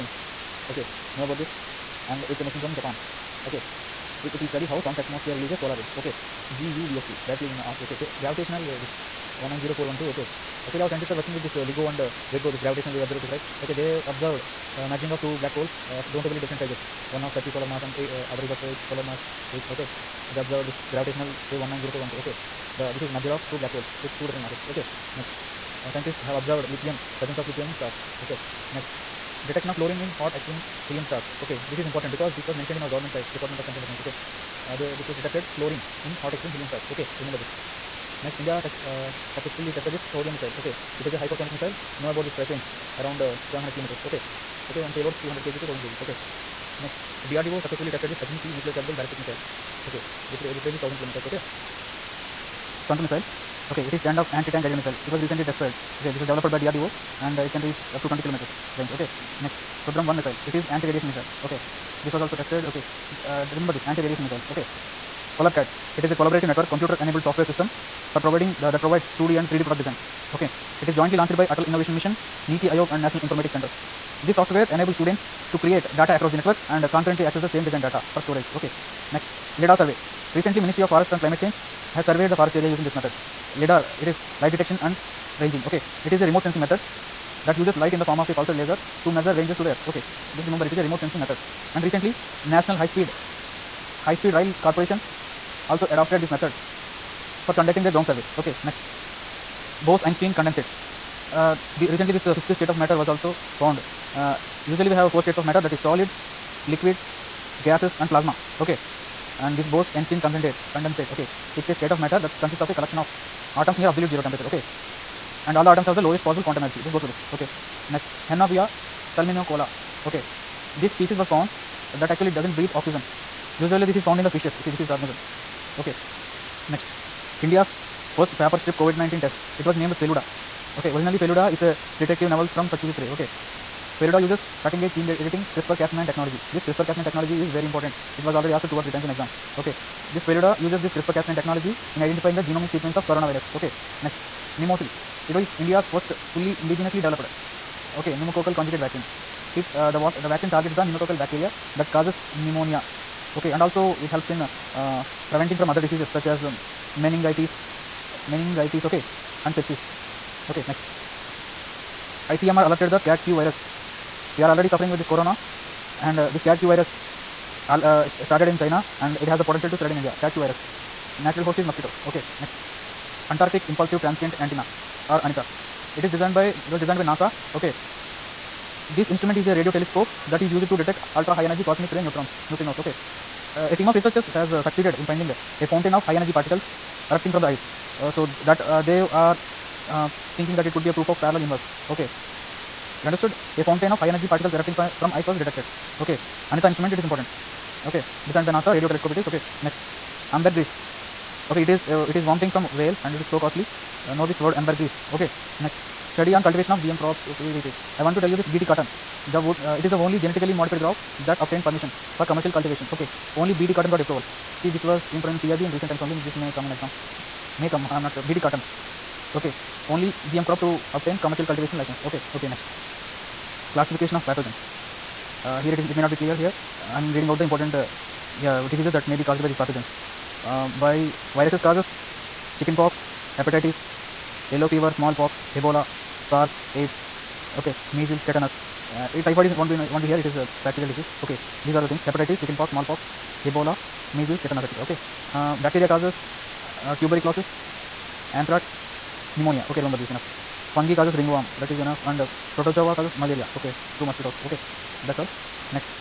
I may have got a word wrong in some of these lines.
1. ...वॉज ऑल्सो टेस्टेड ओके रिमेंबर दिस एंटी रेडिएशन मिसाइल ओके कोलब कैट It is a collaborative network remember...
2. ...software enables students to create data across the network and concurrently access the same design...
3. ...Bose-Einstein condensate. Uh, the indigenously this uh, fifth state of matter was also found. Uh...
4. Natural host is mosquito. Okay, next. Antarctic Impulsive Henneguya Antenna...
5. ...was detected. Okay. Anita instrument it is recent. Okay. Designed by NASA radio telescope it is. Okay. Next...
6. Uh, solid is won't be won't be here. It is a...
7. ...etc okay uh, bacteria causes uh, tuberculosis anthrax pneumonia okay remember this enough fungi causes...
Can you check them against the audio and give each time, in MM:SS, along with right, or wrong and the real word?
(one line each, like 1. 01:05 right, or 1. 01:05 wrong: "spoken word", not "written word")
1. 01:02 wrong: "computer", not "remember"
2. 01:14 right
3. 01:39 wrong: "recently", not "indigenously"
4. 02:51 wrong: "Transient", not "Henneguya"
5. 03:15 wrong: "important", not "recent"
6. 03:58 wrong: "typhoid", not "solid"
7. 04:04 right.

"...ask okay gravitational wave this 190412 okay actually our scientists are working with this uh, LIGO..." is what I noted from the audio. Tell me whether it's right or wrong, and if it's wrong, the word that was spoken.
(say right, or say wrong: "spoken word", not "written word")
right.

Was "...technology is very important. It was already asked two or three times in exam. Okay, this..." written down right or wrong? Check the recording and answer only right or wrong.
right.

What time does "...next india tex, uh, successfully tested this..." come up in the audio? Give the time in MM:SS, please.
00:38.